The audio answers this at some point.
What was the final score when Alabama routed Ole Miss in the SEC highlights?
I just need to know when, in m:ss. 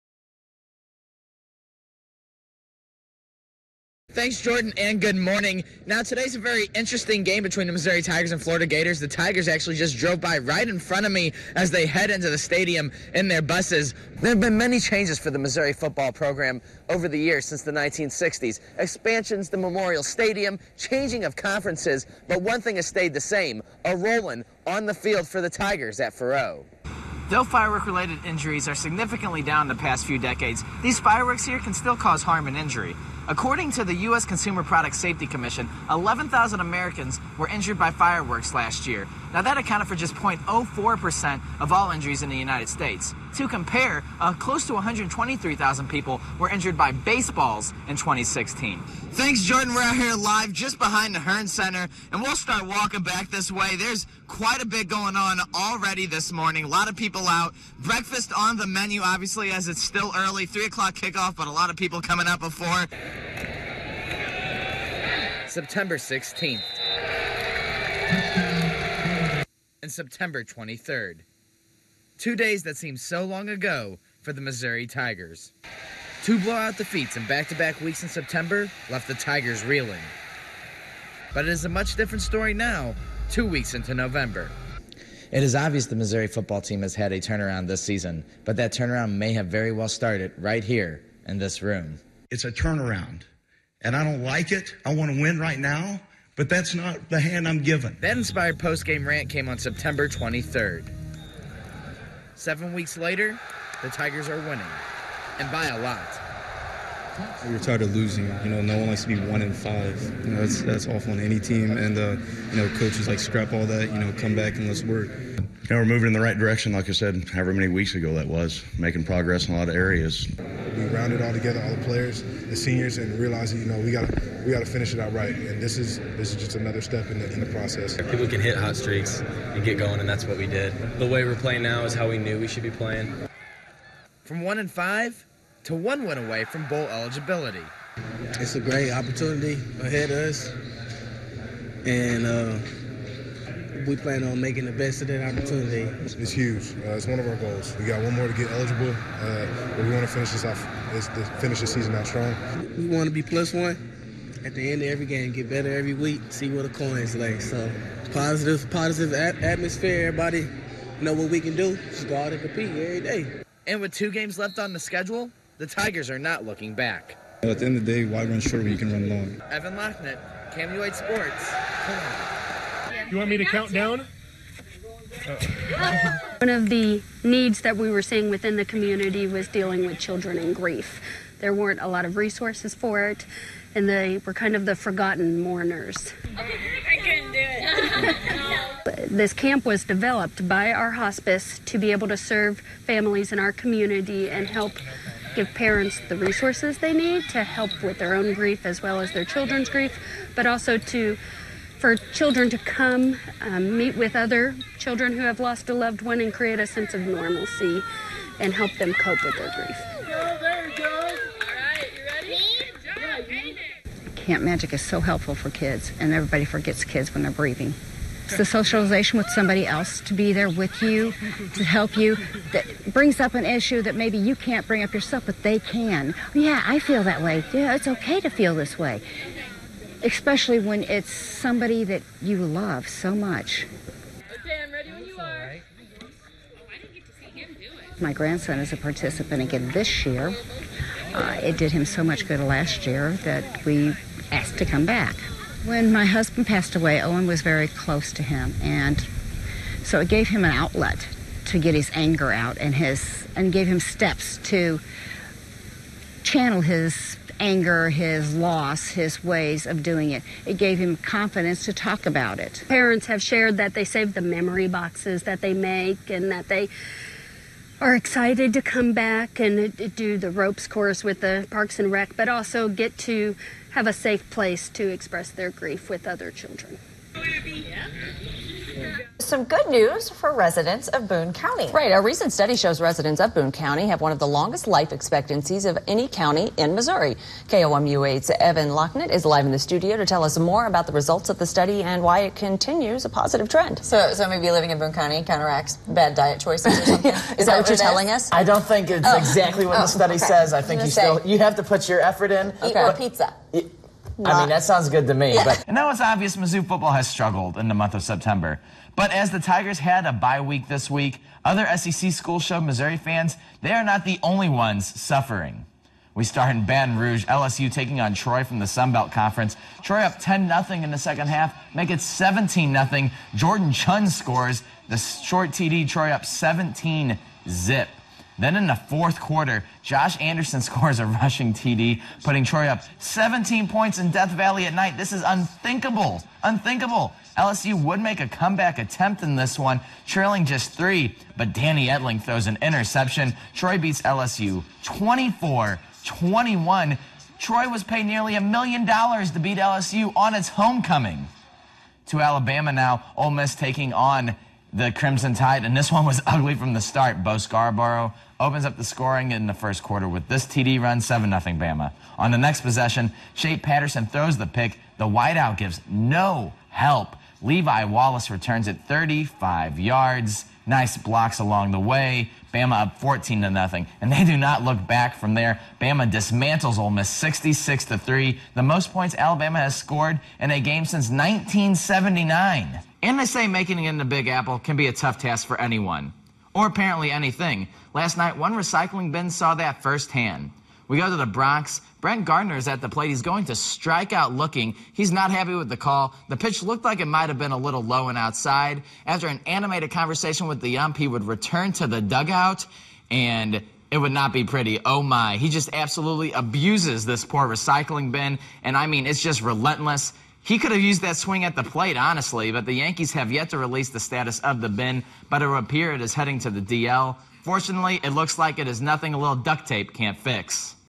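6:17.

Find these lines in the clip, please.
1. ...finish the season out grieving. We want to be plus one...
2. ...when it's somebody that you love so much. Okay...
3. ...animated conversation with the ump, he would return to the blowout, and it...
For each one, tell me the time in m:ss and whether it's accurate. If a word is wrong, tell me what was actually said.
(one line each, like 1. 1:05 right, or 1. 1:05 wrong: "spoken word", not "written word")
1. 2:31 wrong: "strong", not "grieving"
2. 3:50 right
3. 6:39 wrong: "dugout", not "blowout".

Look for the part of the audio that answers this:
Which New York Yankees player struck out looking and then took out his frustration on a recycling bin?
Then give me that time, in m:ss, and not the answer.
6:31.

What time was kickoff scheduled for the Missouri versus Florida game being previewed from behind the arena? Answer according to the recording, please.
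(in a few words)
3 o'clock.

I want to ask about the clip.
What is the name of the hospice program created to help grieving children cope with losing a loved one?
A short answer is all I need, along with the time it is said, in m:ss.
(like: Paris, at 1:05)
Camp Magic, at 3:34.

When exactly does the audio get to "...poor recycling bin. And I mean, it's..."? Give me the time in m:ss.
6:47.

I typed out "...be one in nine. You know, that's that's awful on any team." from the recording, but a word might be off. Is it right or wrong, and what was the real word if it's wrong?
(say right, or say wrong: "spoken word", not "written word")
wrong: "five", not "nine".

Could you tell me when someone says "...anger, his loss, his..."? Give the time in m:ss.
4:17.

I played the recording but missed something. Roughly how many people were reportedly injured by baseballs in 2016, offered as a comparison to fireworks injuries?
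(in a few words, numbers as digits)
123,000.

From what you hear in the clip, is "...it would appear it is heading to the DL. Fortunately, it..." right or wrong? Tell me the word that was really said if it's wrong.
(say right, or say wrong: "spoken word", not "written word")
right.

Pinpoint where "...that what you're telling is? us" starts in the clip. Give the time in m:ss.
4:57.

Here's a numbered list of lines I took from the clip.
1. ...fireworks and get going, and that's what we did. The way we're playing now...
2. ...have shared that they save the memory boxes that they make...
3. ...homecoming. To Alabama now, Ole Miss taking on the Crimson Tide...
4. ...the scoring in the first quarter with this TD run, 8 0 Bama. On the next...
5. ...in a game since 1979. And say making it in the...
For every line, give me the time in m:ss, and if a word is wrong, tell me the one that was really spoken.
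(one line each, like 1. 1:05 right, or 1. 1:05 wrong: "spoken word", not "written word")
1. 2:08 wrong: "streaks", not "fireworks"
2. 4:23 right
3. 5:50 right
4. 5:58 wrong: "7", not "8"
5. 6:20 right.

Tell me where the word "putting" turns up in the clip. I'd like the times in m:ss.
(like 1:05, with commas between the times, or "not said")
5:32.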